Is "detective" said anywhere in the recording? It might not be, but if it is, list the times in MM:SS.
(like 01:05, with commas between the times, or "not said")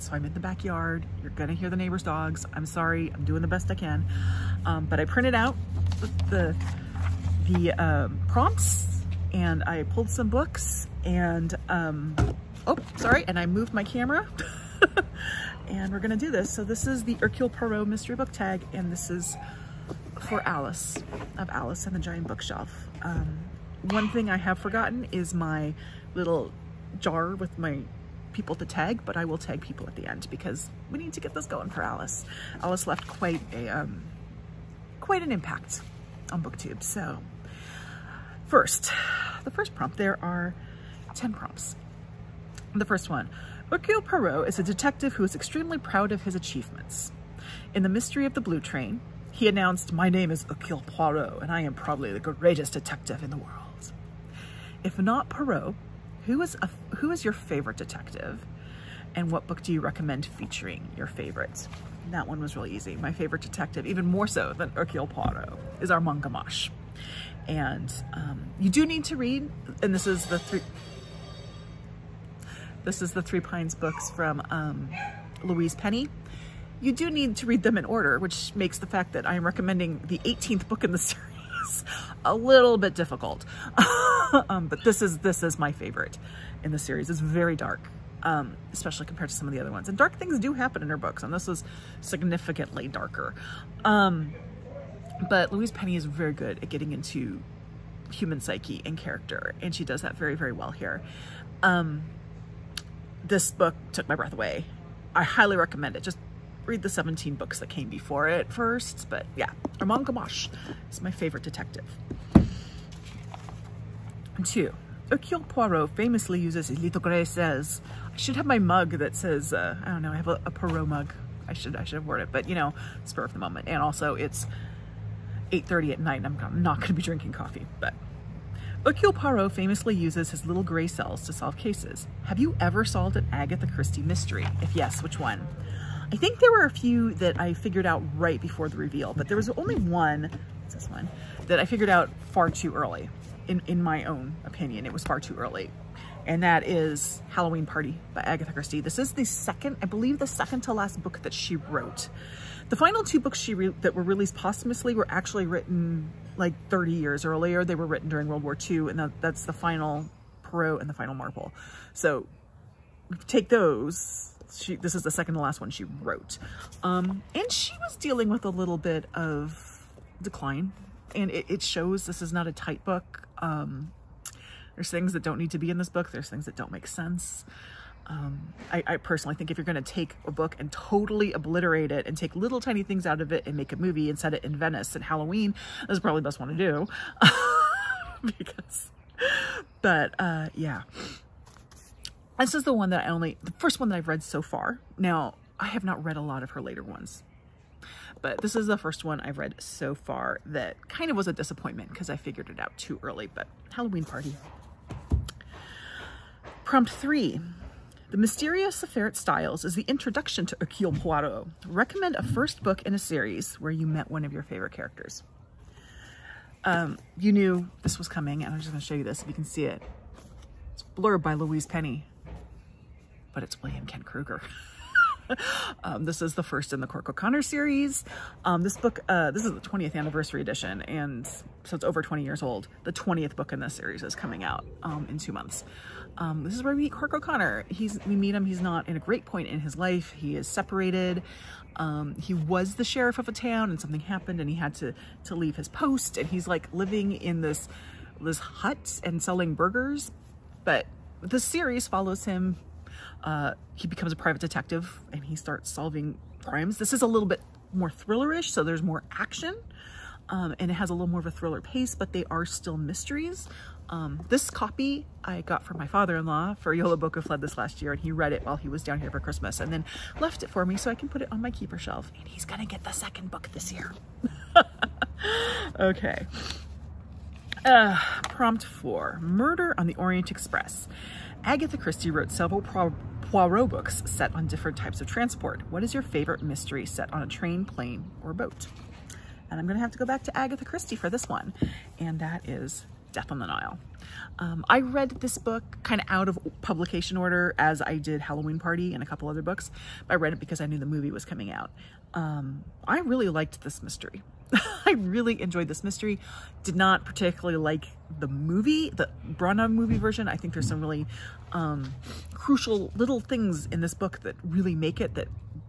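00:44, 00:52, 00:57, 01:03, 01:51, 04:14.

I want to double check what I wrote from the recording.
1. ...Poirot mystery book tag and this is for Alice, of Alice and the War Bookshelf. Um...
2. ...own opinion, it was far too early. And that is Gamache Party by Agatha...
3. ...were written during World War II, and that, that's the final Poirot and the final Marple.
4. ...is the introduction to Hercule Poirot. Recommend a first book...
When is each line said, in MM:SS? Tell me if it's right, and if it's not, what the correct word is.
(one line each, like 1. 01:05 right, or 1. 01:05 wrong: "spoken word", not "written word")
1. 00:17 wrong: "Giant", not "War"
2. 02:24 wrong: "Halloween", not "Gamache"
3. 02:37 right
4. 03:29 right.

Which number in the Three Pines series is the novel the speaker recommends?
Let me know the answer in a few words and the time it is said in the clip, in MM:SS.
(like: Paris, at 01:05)
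18th, at 01:20.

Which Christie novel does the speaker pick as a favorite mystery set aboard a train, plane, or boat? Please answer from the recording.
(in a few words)
Death on the Nile.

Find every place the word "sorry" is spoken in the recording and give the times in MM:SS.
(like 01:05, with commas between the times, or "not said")
00:02, 00:12.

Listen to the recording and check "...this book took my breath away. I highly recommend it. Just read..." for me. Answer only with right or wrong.
right.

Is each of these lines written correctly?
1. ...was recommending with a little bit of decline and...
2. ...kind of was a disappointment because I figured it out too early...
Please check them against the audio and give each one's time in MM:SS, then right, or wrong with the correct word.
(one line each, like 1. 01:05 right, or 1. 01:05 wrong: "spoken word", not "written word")
1. 02:47 wrong: "dealing", not "recommending"
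2. 03:20 right.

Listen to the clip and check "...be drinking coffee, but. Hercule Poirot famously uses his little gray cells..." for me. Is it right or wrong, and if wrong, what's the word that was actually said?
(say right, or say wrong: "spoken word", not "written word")
right.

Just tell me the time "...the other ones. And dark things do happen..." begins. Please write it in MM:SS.
01:29.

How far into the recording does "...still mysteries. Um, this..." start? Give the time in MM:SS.
04:22.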